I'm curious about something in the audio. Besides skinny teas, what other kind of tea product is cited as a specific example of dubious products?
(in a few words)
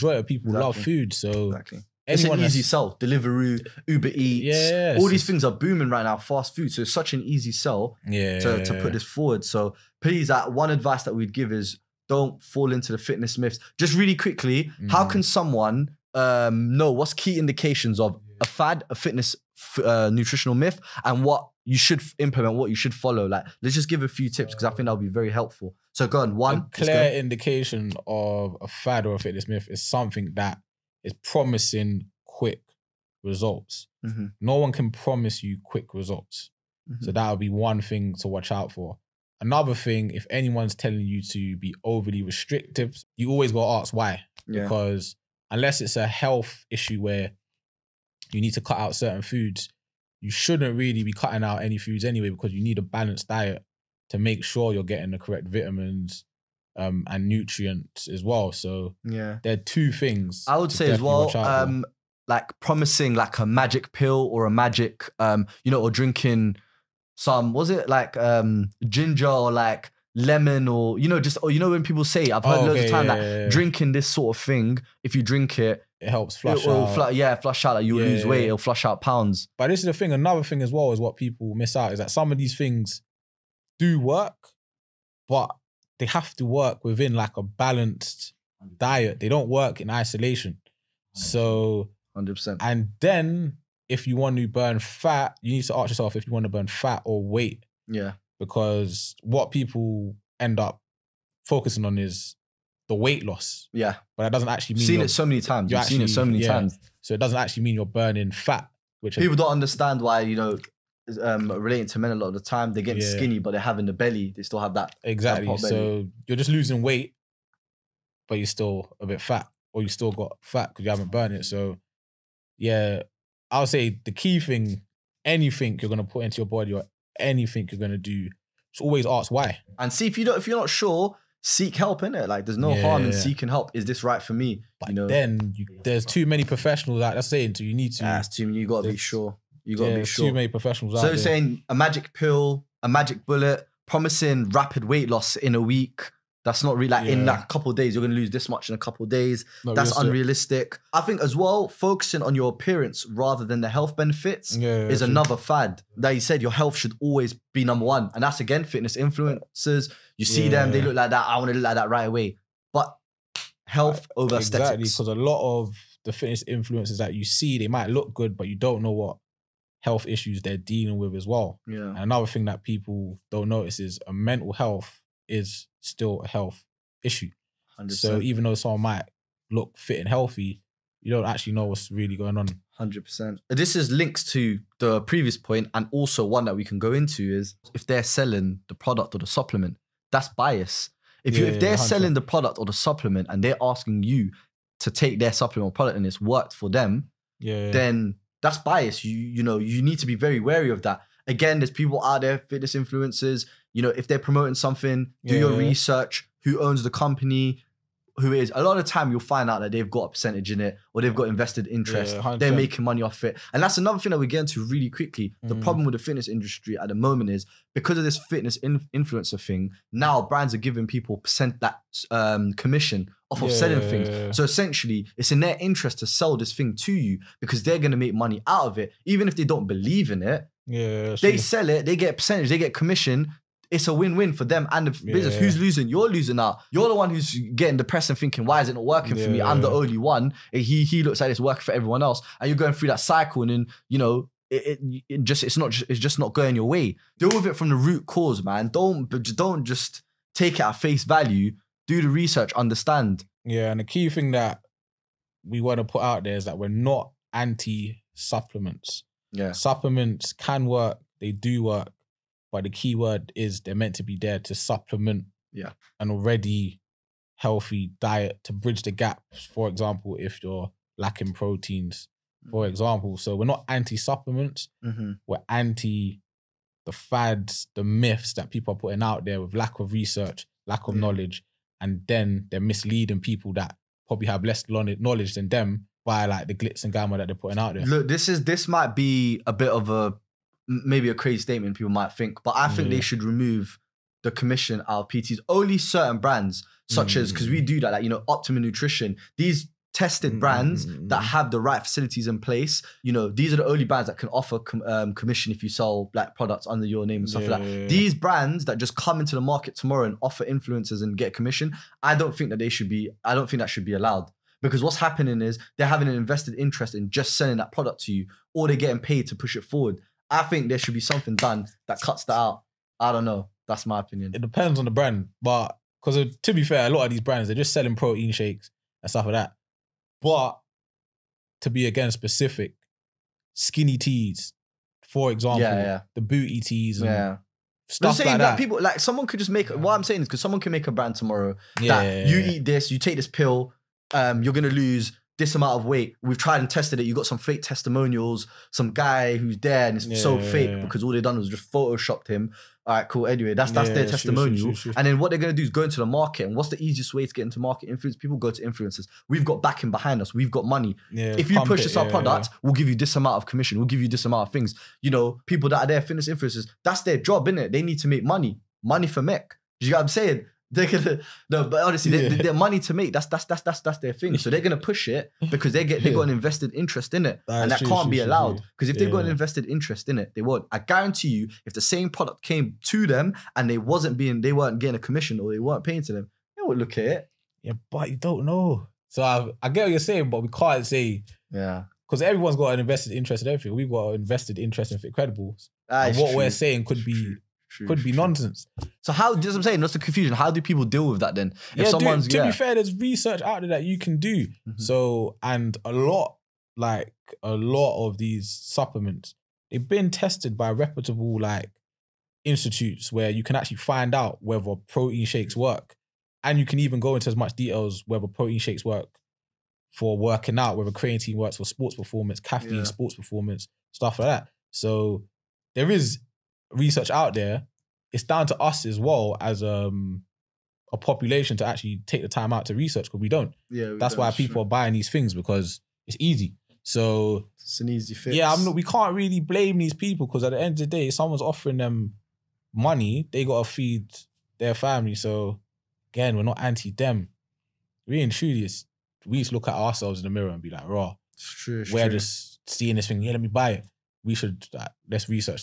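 booty teas.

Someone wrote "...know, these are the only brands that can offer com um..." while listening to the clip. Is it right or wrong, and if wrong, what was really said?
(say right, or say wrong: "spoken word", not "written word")
right.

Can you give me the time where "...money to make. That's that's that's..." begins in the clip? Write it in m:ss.
6:12.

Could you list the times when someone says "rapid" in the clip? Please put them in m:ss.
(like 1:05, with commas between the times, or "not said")
2:24.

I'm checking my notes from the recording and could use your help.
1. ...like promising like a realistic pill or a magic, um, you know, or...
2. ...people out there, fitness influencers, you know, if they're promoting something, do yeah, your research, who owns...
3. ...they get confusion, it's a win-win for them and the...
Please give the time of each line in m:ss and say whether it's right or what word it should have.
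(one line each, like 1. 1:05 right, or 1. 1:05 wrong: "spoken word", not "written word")
1. 1:02 wrong: "magic", not "realistic"
2. 3:21 right
3. 3:52 wrong: "commission", not "confusion".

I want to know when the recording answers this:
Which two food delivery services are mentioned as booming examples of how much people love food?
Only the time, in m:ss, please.
0:02.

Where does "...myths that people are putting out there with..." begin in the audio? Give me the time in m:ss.
4:37.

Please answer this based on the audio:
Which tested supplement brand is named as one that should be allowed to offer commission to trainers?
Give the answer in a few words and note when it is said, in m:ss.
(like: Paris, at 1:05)
Optimum Nutrition, at 4:58.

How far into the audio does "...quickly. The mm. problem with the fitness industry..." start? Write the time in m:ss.
3:34.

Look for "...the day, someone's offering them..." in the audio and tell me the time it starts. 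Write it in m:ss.
7:20.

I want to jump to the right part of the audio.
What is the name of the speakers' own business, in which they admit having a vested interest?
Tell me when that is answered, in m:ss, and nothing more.
6:34.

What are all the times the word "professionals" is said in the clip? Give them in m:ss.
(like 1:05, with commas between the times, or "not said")
2:16, 2:20.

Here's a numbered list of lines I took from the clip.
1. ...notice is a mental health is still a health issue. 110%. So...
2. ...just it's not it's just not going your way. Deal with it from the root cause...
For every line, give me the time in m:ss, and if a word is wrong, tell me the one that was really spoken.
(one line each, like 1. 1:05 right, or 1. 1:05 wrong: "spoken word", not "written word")
1. 2:53 wrong: "100", not "110"
2. 4:05 right.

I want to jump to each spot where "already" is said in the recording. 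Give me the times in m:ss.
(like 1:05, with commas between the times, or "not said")
4:26.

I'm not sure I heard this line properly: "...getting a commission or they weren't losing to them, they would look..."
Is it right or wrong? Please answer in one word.
wrong.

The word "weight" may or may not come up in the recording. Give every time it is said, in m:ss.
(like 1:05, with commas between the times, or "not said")
1:18, 1:37, 1:43, 1:56, 2:24, 5:45.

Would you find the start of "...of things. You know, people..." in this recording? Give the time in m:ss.
6:04.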